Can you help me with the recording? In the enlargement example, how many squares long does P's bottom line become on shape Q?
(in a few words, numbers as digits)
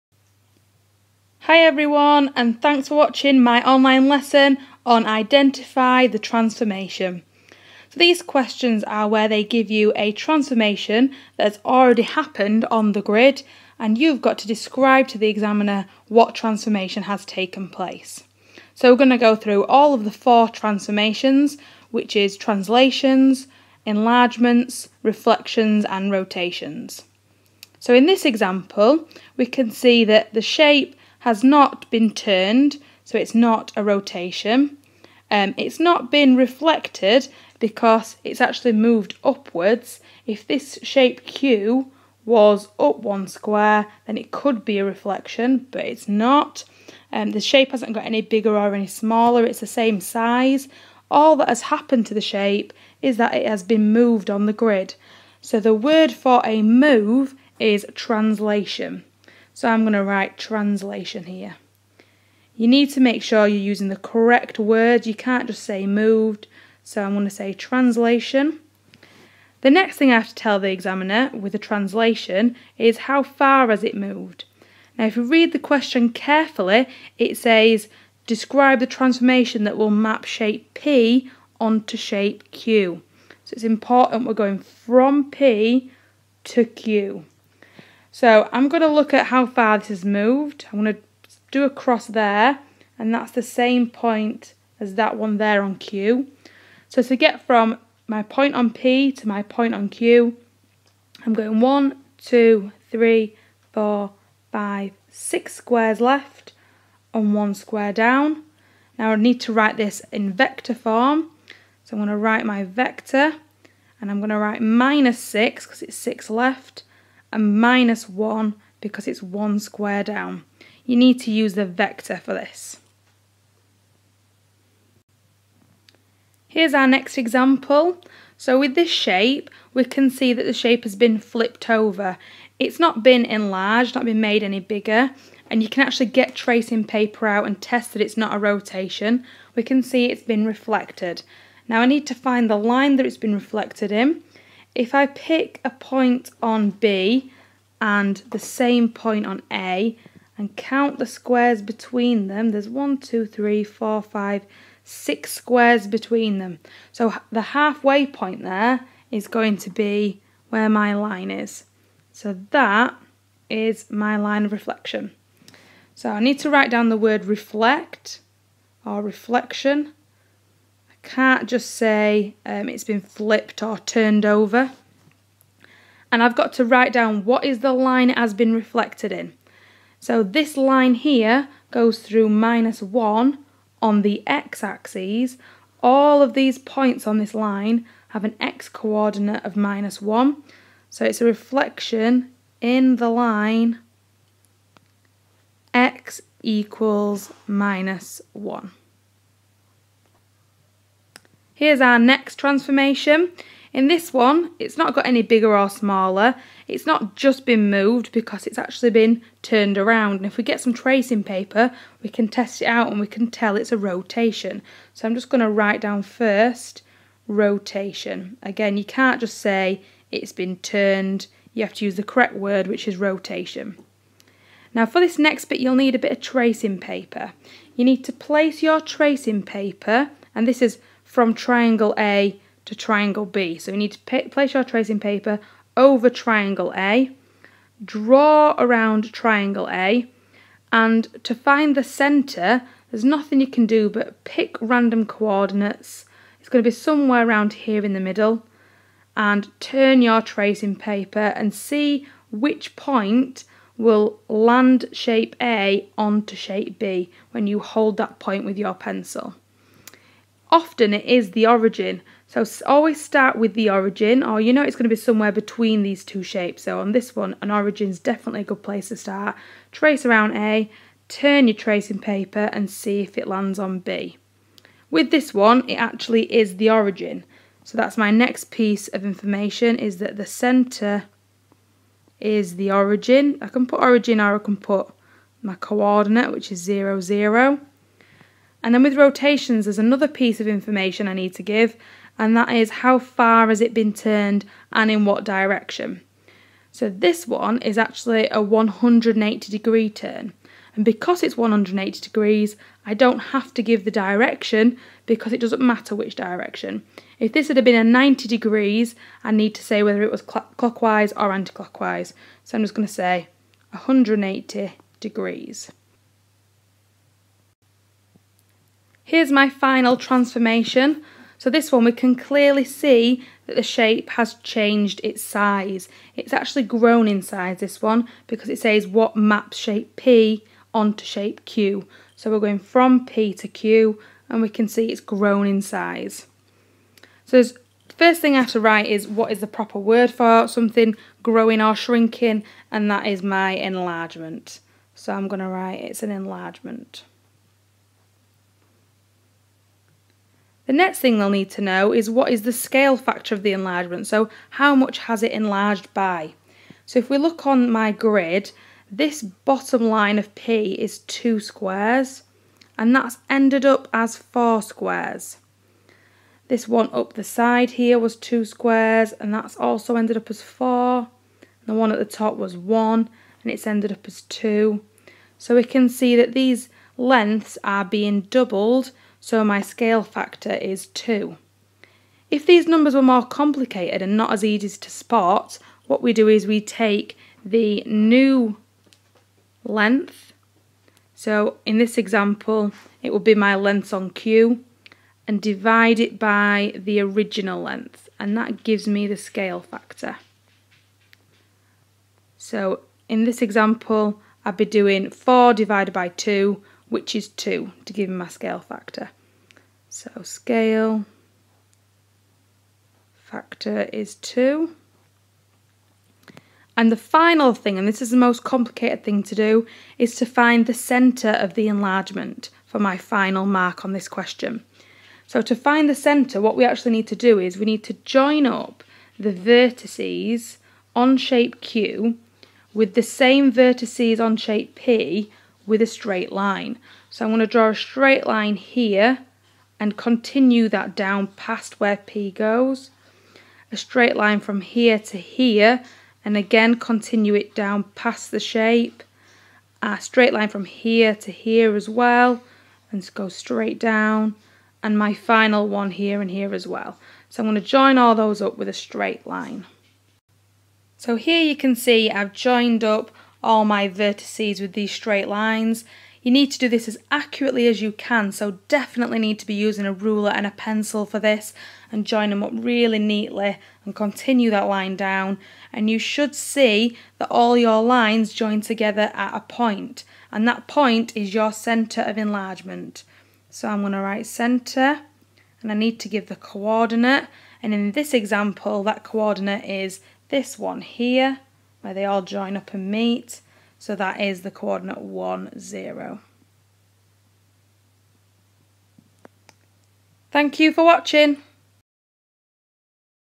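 4.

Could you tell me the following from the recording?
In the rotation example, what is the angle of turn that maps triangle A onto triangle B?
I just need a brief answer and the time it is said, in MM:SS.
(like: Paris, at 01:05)
180 degrees, at 04:58.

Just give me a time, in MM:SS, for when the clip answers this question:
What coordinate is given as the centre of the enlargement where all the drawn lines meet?
08:15.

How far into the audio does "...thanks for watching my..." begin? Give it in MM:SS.
00:02.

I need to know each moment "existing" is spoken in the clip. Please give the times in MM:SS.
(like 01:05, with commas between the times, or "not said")
not said.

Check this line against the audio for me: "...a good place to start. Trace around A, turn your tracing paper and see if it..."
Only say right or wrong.
right.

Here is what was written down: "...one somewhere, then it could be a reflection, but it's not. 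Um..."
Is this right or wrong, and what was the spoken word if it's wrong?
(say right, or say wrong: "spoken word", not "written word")
wrong: "square", not "somewhere".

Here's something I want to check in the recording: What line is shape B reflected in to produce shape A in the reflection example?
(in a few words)
x = -1.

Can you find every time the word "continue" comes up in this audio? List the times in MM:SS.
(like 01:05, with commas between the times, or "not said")
07:19, 07:26, 07:53.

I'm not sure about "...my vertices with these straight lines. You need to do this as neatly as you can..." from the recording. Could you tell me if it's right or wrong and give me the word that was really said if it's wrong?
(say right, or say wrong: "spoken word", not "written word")
wrong: "accurately", not "neatly".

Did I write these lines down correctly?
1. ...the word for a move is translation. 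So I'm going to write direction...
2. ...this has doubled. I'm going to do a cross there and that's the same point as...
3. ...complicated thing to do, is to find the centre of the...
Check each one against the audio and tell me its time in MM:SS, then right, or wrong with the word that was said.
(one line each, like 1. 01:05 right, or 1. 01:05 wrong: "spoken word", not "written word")
1. 00:55 wrong: "translation", not "direction"
2. 01:29 wrong: "moved", not "doubled"
3. 06:58 right.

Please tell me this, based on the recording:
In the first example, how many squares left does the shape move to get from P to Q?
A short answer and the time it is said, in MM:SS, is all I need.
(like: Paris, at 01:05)
6, at 01:45.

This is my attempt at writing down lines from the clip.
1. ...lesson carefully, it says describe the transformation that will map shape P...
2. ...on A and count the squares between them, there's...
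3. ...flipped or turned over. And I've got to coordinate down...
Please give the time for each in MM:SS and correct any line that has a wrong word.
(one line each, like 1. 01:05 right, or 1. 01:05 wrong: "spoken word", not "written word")
1. 01:15 wrong: "question", not "lesson"
2. 02:29 right
3. 02:53 wrong: "write", not "coordinate".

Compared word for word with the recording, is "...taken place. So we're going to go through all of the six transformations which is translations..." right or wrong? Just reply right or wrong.
wrong.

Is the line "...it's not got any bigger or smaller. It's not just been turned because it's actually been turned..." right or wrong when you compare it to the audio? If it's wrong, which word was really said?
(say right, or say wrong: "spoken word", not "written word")
wrong: "moved", not "turned".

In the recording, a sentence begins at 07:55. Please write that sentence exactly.
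And you should see that all your lines join together at a point, and that point is your centre of enlargement.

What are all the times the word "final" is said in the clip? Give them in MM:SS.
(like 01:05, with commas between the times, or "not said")
05:19, 06:56, 07:02, 07:35.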